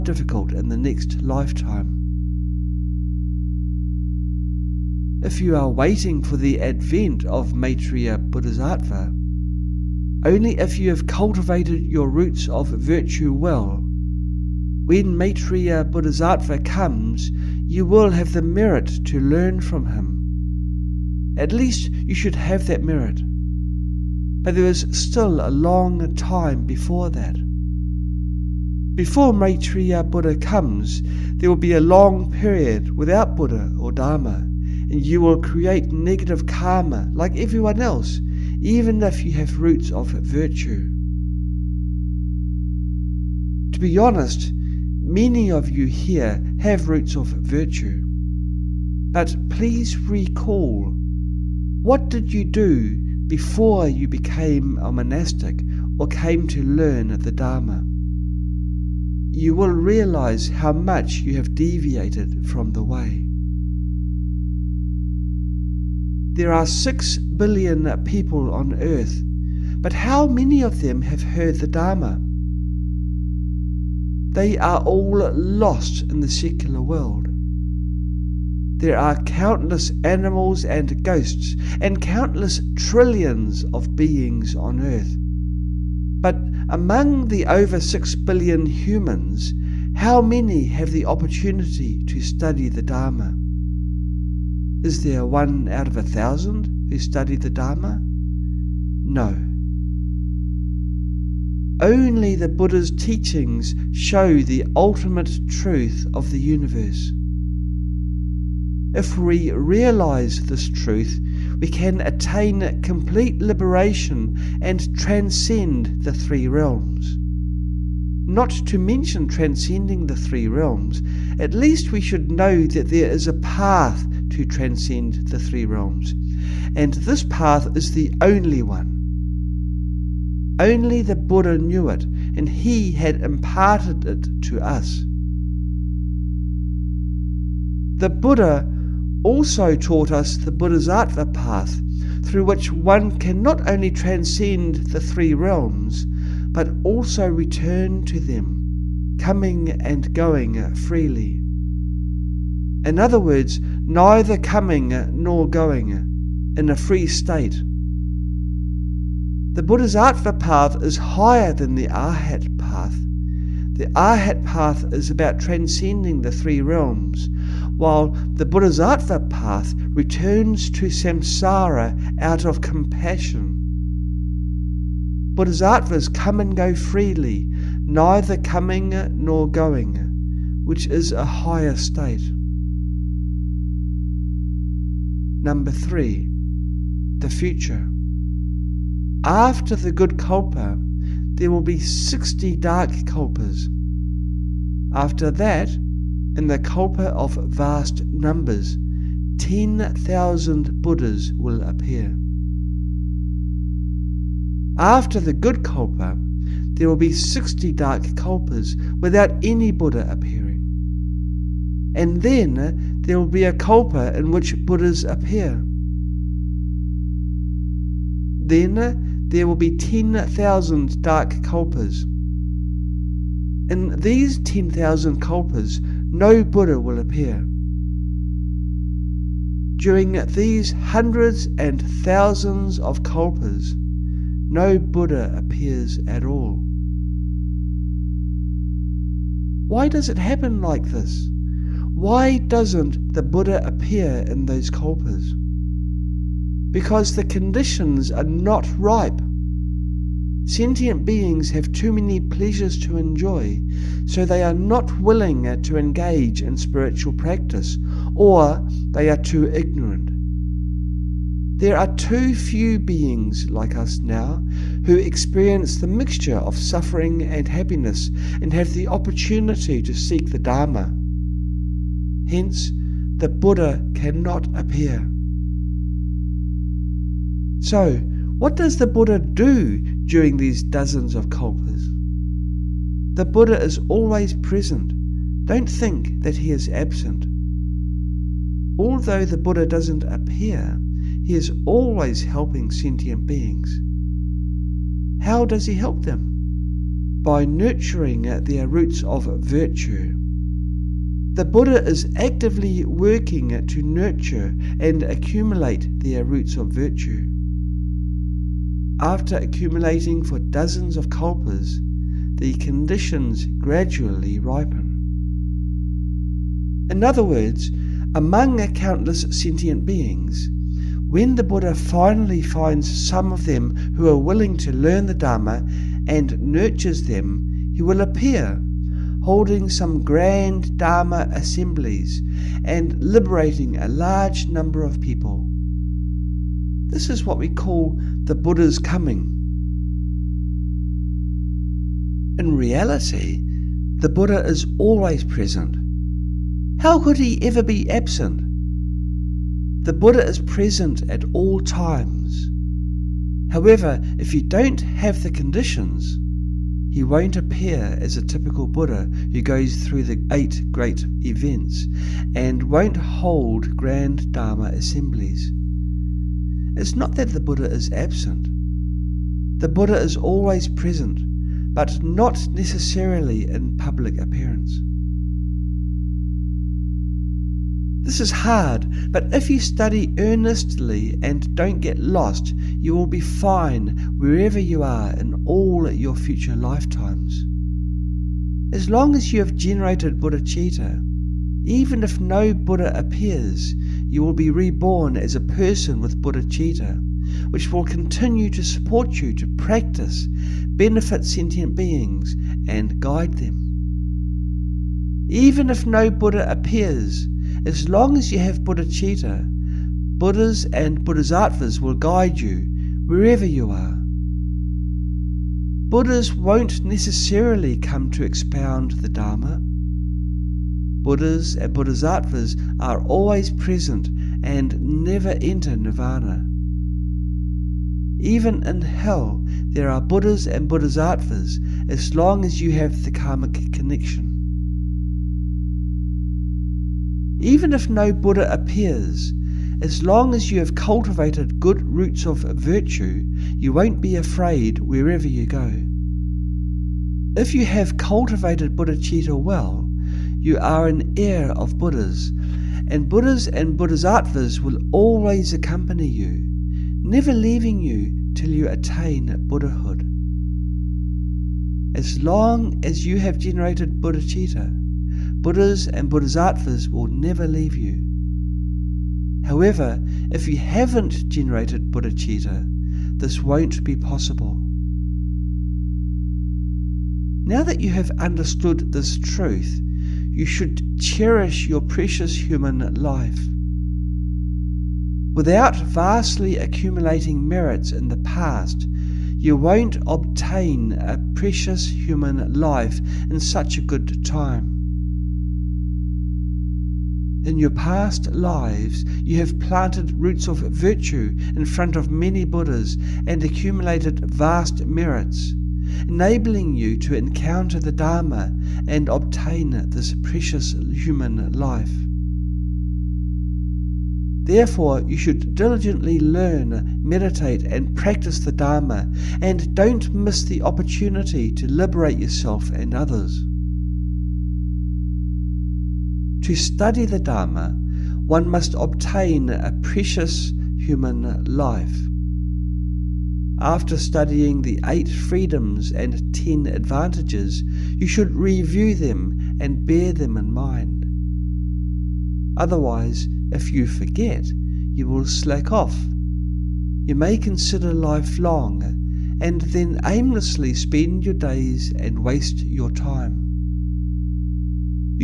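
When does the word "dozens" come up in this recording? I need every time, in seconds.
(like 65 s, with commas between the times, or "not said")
280 s, 310 s.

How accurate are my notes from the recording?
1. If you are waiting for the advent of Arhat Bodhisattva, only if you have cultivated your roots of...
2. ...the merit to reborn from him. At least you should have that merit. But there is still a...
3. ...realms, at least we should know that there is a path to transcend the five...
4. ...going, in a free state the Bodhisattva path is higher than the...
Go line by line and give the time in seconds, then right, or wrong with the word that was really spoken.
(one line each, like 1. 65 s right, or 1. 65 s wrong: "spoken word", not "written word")
1. 5 s wrong: "Maitreya", not "Arhat"
2. 18 s wrong: "learn", not "reborn"
3. 120 s wrong: "three", not "five"
4. 155 s right.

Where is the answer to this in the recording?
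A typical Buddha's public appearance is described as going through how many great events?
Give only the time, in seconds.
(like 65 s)
360 s.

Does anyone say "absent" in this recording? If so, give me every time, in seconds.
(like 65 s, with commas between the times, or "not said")
286 s, 347 s, 367 s.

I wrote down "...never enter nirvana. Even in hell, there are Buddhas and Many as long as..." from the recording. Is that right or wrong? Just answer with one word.
wrong.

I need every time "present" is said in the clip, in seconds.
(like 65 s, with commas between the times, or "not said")
284 s, 345 s, 350 s, 370 s, 423 s.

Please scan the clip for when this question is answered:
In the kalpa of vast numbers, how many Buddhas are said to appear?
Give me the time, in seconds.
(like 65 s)
199 s.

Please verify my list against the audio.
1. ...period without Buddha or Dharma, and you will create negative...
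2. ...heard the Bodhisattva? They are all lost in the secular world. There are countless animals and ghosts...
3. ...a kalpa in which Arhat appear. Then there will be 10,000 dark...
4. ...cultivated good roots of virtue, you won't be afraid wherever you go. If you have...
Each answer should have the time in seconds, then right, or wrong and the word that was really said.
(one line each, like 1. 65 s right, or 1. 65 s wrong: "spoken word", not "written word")
1. 32 s right
2. 71 s wrong: "Dharma", not "Bodhisattva"
3. 213 s wrong: "Buddhas", not "Arhat"
4. 440 s right.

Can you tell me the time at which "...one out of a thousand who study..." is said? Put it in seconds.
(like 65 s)
95 s.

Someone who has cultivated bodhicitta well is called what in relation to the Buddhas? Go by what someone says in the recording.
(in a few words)
An heir of Buddhas.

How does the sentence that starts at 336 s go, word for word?
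This is what we call the Buddha's coming.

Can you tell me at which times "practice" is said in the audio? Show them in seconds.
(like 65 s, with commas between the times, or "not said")
257 s, 399 s, 517 s.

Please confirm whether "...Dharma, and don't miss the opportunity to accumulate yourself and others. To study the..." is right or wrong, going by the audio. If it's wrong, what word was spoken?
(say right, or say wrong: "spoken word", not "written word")
wrong: "liberate", not "accumulate".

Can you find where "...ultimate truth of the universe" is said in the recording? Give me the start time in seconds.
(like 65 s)
104 s.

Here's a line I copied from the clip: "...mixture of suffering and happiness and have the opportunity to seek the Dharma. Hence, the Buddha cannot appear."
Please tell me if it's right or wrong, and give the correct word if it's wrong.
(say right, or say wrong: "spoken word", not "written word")
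right.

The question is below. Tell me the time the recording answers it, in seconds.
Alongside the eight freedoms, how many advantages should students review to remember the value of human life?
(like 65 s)
536 s.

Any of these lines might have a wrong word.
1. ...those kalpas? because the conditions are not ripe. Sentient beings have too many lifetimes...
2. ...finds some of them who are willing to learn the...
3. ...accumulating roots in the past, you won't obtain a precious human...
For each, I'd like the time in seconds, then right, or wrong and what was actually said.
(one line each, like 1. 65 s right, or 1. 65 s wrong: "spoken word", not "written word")
1. 244 s wrong: "pleasures", not "lifetimes"
2. 322 s right
3. 486 s wrong: "merits", not "roots".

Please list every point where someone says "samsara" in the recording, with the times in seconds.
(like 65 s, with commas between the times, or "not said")
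170 s.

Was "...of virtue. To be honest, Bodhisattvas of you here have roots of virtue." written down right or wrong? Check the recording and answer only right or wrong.
wrong.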